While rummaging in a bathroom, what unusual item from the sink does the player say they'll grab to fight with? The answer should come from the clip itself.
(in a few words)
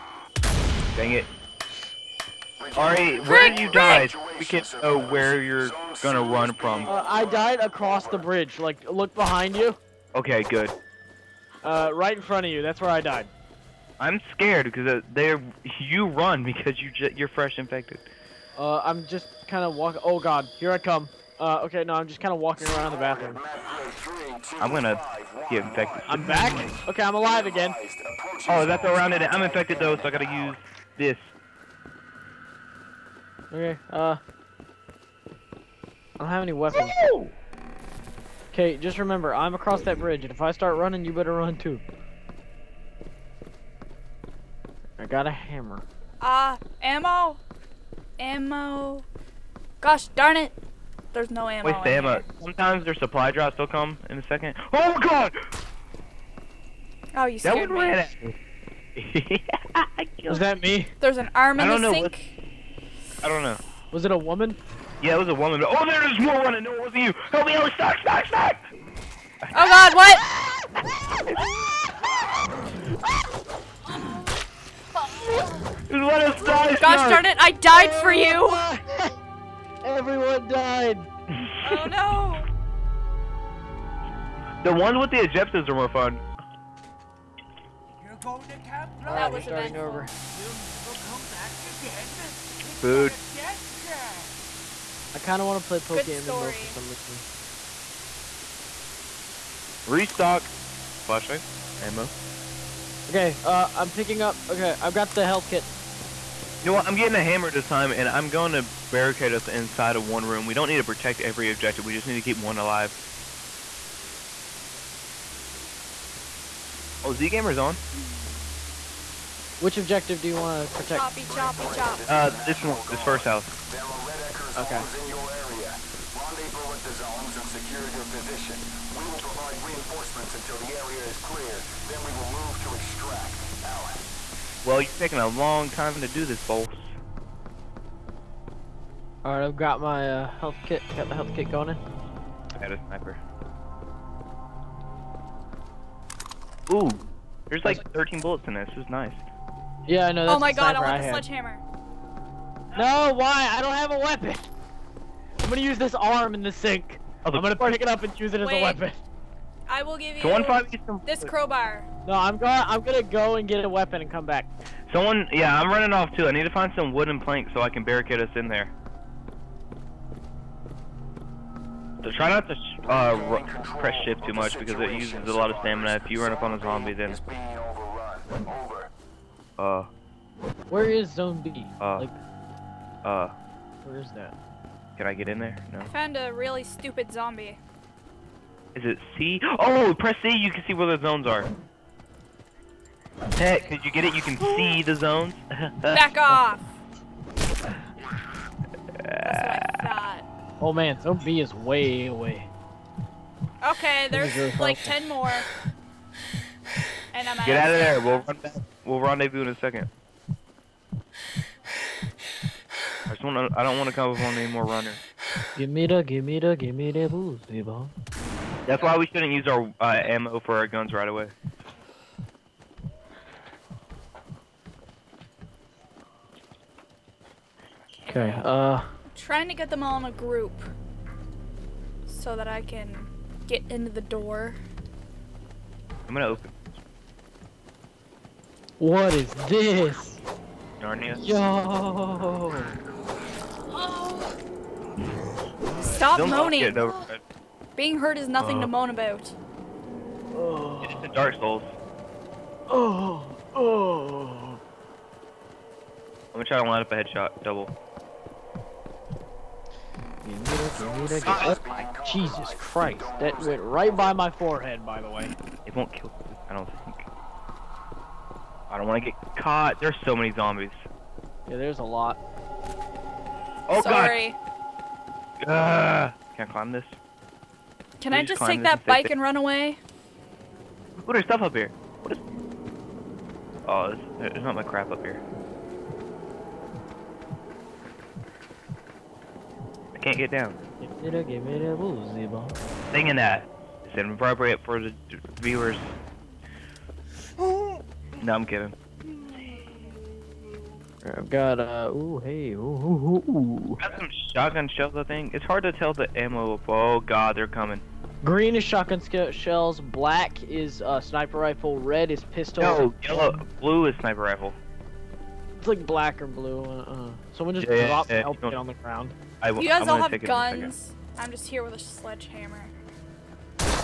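An arm.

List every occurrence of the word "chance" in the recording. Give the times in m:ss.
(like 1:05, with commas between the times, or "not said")
not said.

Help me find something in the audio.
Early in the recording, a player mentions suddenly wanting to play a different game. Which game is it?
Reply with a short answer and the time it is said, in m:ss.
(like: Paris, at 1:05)
Pokemon, at 1:35.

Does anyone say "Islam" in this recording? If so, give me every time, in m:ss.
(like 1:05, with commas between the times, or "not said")
not said.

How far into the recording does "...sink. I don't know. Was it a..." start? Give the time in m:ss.
1:01.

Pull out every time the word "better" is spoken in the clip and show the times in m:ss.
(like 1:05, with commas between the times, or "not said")
0:41.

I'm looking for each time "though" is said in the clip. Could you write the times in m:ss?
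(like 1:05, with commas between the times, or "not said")
0:29.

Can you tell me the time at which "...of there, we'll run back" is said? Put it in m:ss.
3:27.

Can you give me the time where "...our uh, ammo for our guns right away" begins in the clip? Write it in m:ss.
3:39.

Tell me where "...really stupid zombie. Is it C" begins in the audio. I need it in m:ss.
3:06.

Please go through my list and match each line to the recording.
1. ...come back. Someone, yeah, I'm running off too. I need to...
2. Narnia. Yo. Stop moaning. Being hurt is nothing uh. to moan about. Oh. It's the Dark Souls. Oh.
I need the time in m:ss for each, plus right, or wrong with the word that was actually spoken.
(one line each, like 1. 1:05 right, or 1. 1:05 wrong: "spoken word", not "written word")
1. 2:44 right
2. 4:00 right.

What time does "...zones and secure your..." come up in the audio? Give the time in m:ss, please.
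2:06.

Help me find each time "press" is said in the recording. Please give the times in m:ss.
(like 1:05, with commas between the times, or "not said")
2:53, 3:09.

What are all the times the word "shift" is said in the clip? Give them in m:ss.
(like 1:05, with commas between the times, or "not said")
2:54.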